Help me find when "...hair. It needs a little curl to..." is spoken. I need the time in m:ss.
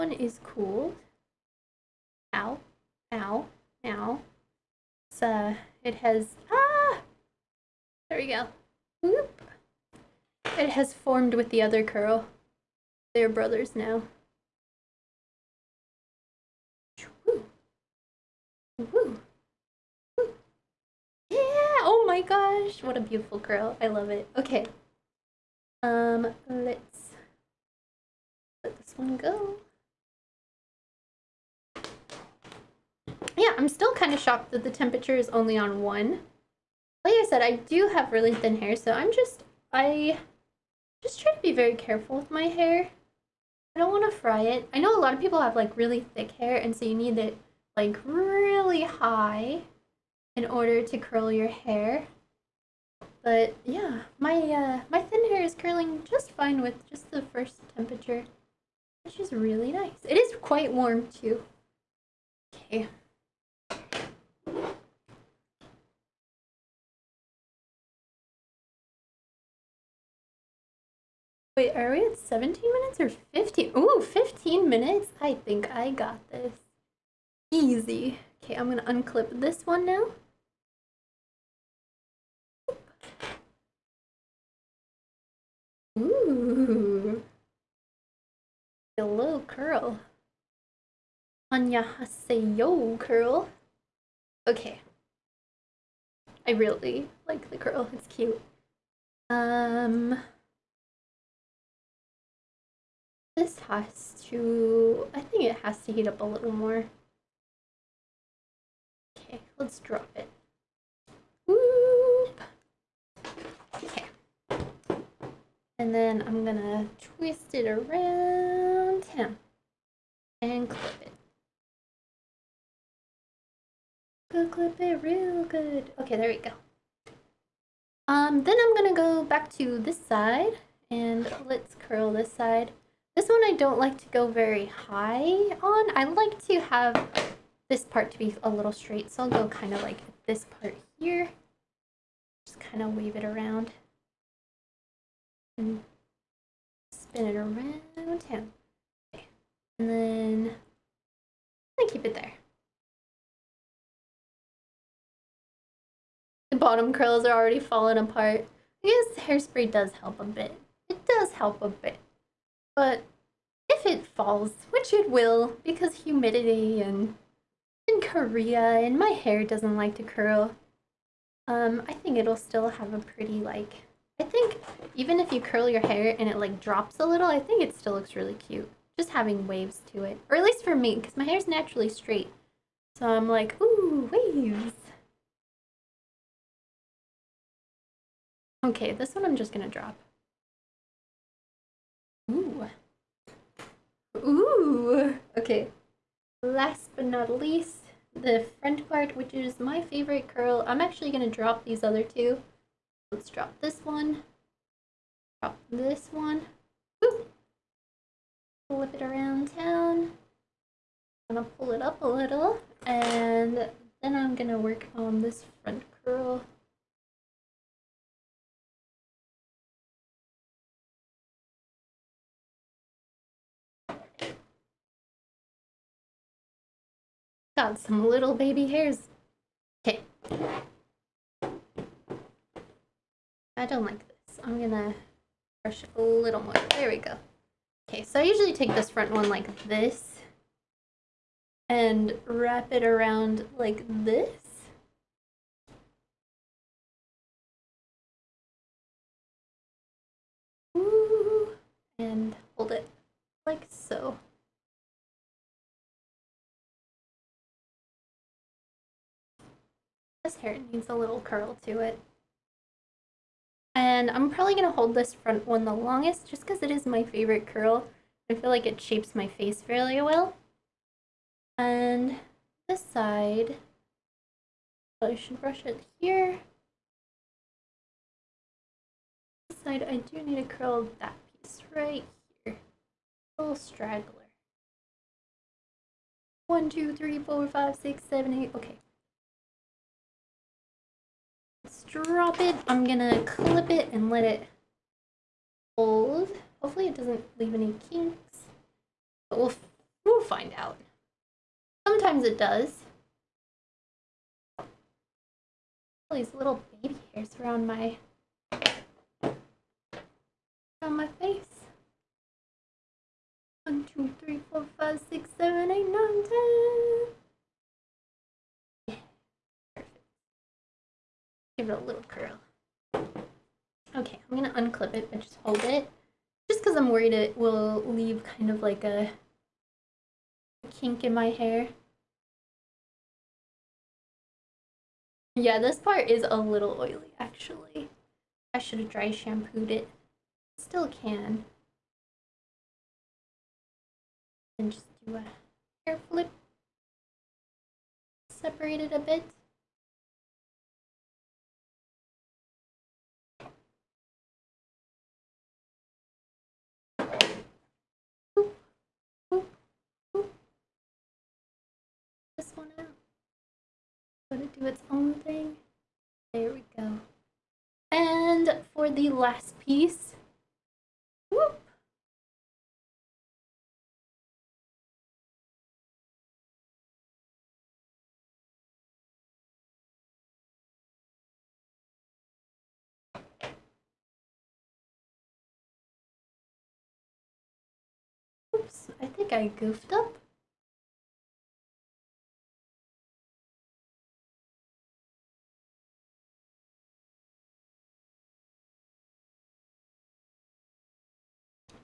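4:20.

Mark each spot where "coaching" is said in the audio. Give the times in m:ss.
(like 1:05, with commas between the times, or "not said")
not said.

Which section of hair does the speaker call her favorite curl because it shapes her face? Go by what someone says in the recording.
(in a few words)
The front part.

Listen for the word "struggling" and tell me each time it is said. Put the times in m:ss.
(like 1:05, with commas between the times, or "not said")
not said.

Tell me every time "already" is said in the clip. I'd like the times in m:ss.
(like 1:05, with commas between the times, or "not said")
2:37.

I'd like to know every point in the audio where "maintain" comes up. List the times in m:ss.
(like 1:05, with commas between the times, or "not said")
not said.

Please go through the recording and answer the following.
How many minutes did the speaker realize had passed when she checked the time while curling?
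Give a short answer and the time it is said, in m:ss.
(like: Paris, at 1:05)
15, at 1:14.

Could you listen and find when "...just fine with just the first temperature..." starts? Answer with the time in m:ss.
0:56.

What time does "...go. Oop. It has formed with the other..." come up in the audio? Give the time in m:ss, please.
0:08.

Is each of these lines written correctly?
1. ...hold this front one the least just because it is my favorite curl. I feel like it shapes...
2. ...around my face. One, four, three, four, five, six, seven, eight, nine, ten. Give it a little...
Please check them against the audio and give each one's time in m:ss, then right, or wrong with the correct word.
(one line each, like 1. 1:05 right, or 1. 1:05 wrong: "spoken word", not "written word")
1. 4:24 wrong: "longest", not "least"
2. 5:09 wrong: "two", not "four".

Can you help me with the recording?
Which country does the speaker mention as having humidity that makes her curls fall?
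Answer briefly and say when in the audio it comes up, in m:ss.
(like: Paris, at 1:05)
Korea, at 2:47.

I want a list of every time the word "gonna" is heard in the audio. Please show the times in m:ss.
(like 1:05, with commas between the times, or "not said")
1:56, 2:08, 3:09, 3:54, 4:52, 5:24.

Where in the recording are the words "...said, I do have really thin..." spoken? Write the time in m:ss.
0:37.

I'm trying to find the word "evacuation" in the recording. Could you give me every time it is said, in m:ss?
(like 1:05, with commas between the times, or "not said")
not said.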